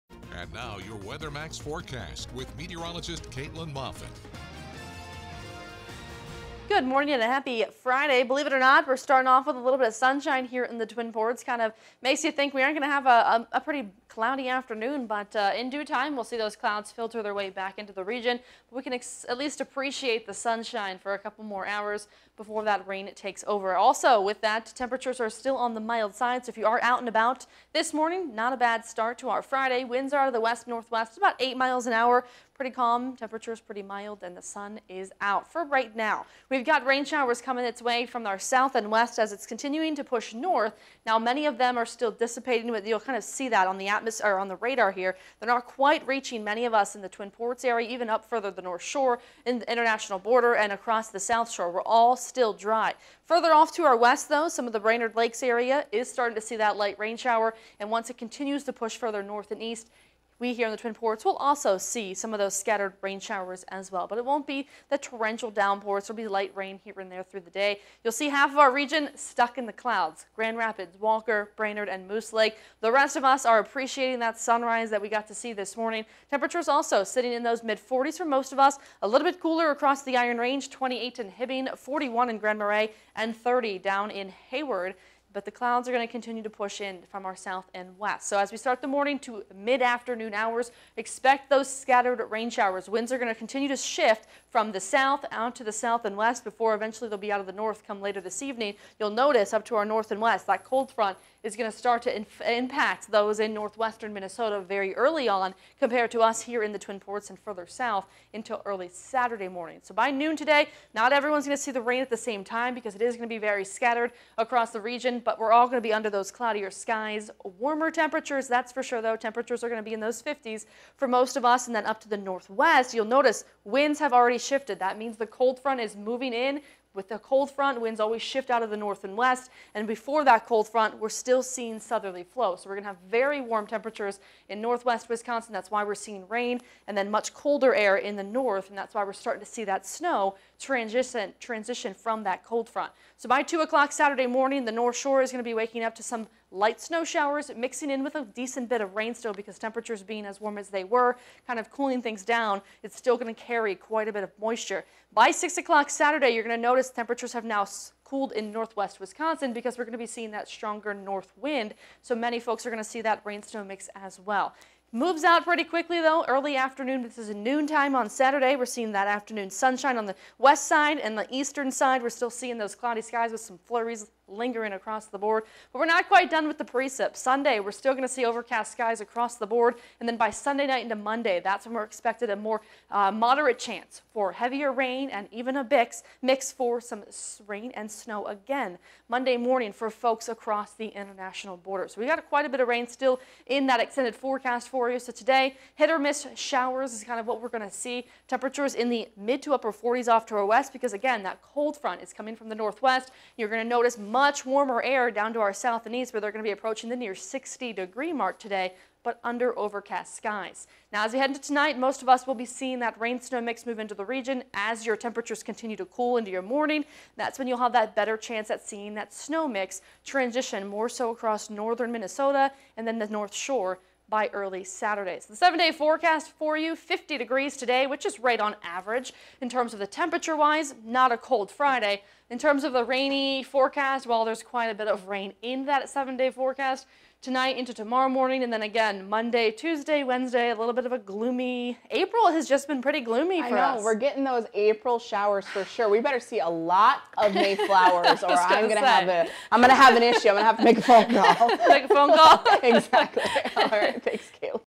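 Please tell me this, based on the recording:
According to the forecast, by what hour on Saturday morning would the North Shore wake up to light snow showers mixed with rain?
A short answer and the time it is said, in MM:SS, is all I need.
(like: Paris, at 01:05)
2 o'clock, at 02:23.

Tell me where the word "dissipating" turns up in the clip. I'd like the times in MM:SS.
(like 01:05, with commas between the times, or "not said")
00:42.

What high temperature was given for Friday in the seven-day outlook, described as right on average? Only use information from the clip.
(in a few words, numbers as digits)
50 degrees.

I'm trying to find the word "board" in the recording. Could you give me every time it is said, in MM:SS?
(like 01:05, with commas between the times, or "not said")
02:55, 02:59.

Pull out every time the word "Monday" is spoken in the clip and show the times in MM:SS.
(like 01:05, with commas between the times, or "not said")
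03:00, 03:09, 03:59.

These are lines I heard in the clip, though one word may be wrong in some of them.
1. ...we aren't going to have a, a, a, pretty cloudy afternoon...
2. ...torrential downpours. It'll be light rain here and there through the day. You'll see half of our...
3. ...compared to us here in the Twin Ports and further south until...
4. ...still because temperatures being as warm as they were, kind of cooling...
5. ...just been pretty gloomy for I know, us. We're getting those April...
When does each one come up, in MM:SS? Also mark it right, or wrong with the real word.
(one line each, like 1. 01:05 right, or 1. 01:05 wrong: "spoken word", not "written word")
1. 00:12 right
2. 01:04 right
3. 01:45 right
4. 02:29 right
5. 04:02 right.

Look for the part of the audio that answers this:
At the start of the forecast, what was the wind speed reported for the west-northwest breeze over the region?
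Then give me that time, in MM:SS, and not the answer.
00:31.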